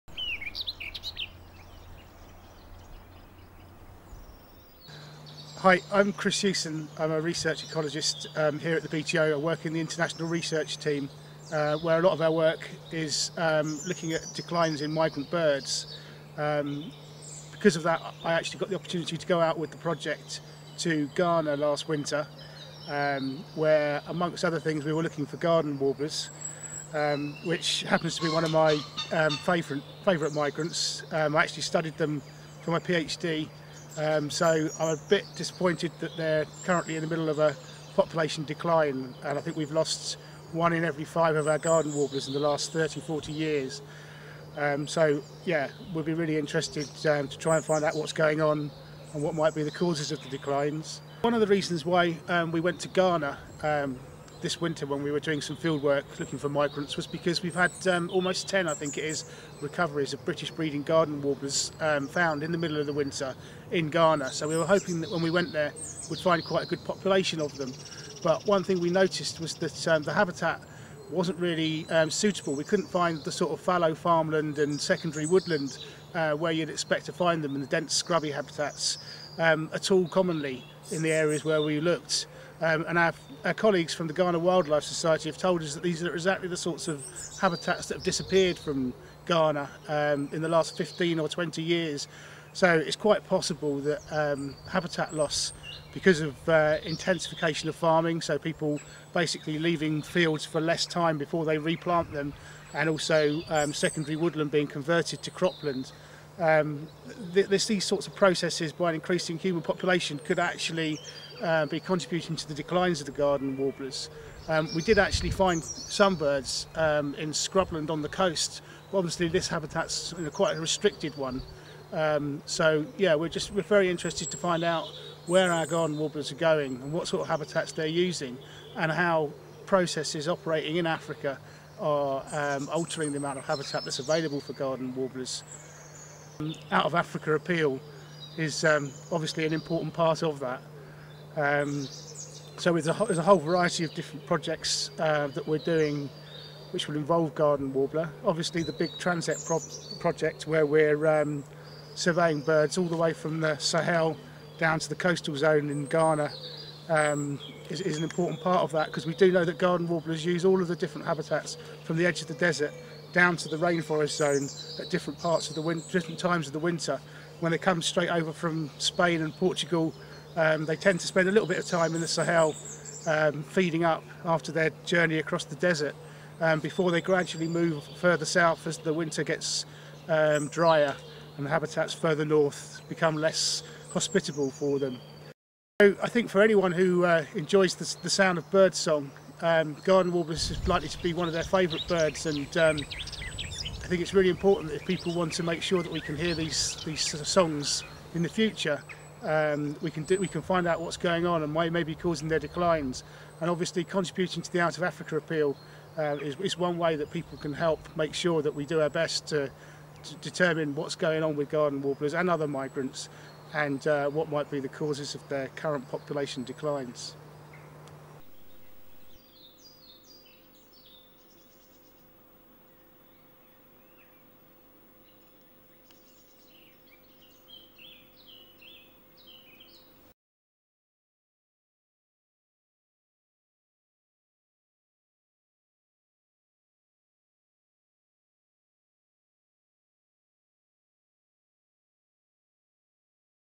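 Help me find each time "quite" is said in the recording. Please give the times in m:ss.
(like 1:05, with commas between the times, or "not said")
1:06, 1:32, 2:00.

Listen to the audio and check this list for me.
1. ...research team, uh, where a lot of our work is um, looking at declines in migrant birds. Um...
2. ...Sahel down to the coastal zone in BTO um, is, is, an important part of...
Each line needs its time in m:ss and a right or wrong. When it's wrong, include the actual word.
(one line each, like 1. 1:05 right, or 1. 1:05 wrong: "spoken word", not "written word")
1. 0:10 right
2. 2:33 wrong: "Ghana", not "BTO".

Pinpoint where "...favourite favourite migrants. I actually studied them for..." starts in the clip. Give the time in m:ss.
0:29.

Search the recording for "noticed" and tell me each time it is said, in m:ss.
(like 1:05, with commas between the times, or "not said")
1:08.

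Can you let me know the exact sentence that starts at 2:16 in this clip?
Um, out of Africa appeal is um, obviously an important part of that.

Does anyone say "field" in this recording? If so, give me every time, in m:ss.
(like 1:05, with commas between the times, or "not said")
0:55, 1:40.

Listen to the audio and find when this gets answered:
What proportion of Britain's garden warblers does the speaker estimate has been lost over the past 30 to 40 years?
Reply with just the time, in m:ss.
0:40.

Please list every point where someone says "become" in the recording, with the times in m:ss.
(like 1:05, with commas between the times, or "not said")
3:02.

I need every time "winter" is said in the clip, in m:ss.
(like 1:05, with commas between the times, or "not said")
0:21, 0:54, 1:02, 2:46, 2:58.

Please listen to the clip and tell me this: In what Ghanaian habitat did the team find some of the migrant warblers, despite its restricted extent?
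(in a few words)
scrubland on the coast.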